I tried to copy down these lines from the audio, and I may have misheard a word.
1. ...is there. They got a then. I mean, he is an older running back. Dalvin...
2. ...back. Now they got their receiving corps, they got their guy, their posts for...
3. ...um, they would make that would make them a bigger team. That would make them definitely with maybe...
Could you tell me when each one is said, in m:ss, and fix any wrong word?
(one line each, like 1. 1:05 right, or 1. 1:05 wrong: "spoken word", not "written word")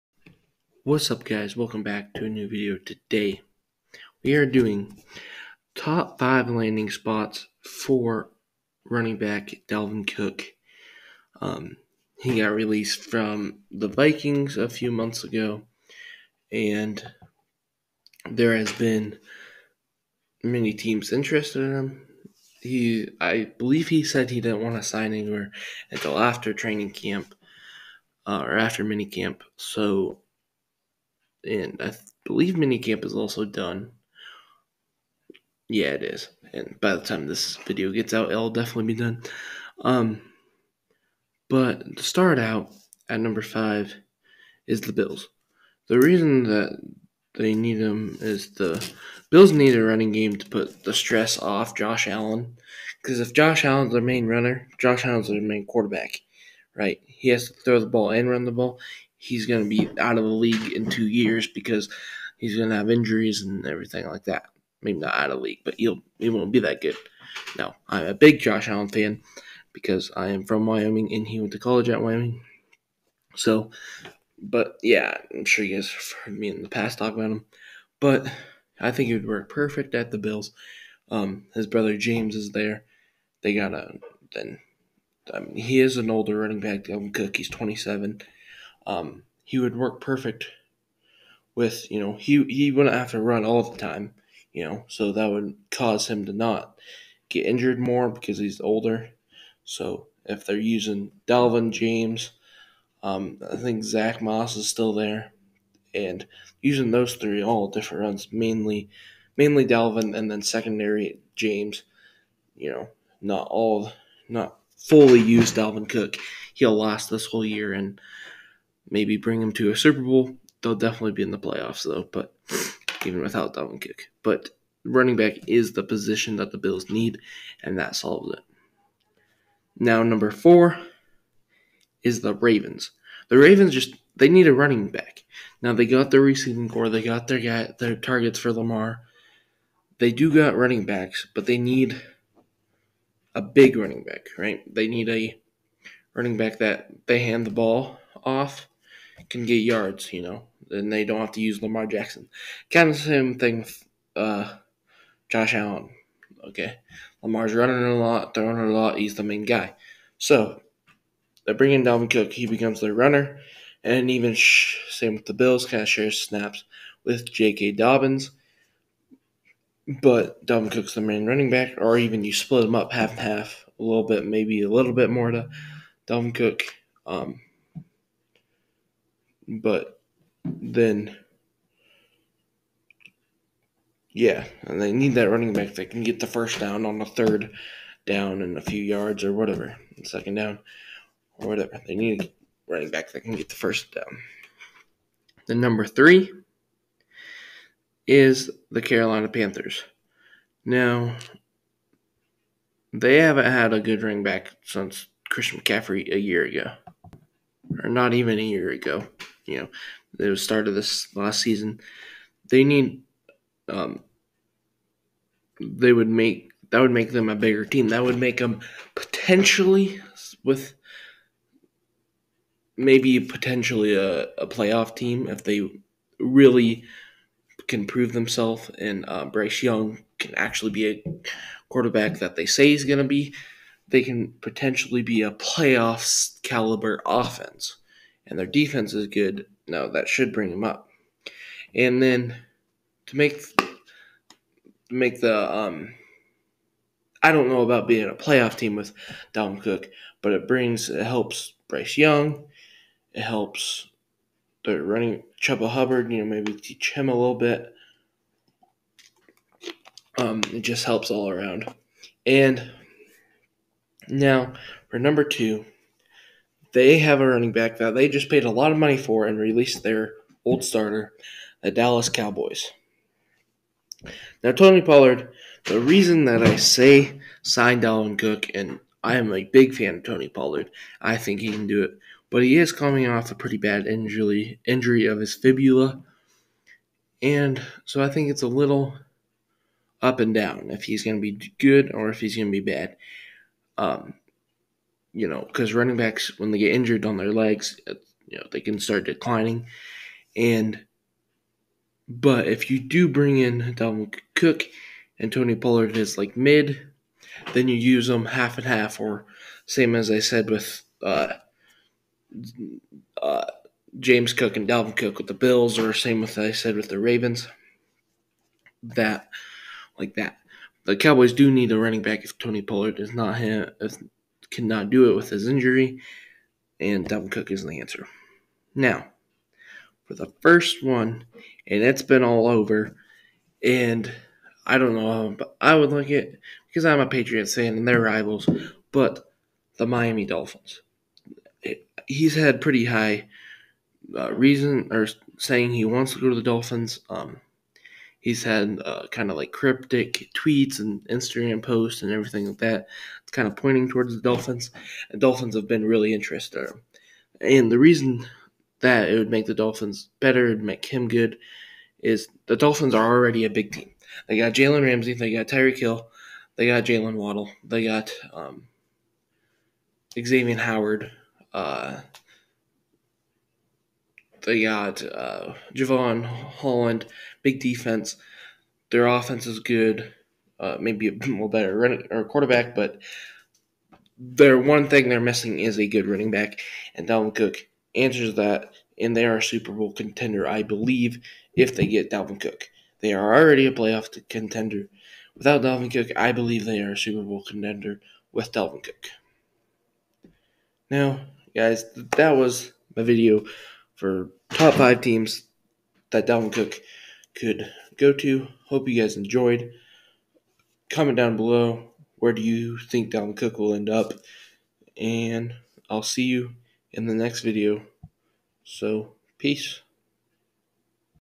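1. 1:22 right
2. 2:14 wrong: "targets", not "posts"
3. 3:33 wrong: "potentially", not "definitely".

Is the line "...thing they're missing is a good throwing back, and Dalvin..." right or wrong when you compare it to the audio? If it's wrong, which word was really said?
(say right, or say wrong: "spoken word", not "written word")
wrong: "running", not "throwing".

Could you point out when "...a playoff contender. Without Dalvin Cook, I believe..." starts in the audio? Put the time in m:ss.
6:33.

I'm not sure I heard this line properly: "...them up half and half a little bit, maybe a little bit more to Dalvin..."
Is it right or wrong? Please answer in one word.
right.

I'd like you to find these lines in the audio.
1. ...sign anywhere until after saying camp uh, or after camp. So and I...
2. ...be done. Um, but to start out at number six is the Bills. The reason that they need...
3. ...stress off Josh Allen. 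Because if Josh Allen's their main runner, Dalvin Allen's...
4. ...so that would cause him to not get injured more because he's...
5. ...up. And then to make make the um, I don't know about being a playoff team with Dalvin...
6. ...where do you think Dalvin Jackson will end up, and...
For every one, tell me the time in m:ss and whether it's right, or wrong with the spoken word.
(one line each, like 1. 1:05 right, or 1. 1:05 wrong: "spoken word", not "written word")
1. 0:24 wrong: "training", not "saying"
2. 0:38 wrong: "five", not "six"
3. 0:50 wrong: "Josh", not "Dalvin"
4. 1:34 right
5. 4:00 right
6. 6:52 wrong: "Cook", not "Jackson".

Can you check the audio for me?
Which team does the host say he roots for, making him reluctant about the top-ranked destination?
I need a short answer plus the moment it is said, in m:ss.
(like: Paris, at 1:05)
Patriots, at 5:37.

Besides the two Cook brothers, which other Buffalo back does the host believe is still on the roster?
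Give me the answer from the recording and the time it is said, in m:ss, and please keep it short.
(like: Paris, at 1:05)
Zack Moss, at 1:43.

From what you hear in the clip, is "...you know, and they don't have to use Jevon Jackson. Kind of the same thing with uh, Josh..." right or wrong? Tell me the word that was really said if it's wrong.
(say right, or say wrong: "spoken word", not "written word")
wrong: "Lamar", not "Jevon".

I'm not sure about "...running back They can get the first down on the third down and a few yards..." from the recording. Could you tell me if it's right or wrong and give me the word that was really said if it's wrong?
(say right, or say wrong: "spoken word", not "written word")
right.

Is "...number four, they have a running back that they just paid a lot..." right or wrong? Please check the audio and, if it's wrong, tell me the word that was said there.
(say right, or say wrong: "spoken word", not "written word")
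wrong: "two", not "four".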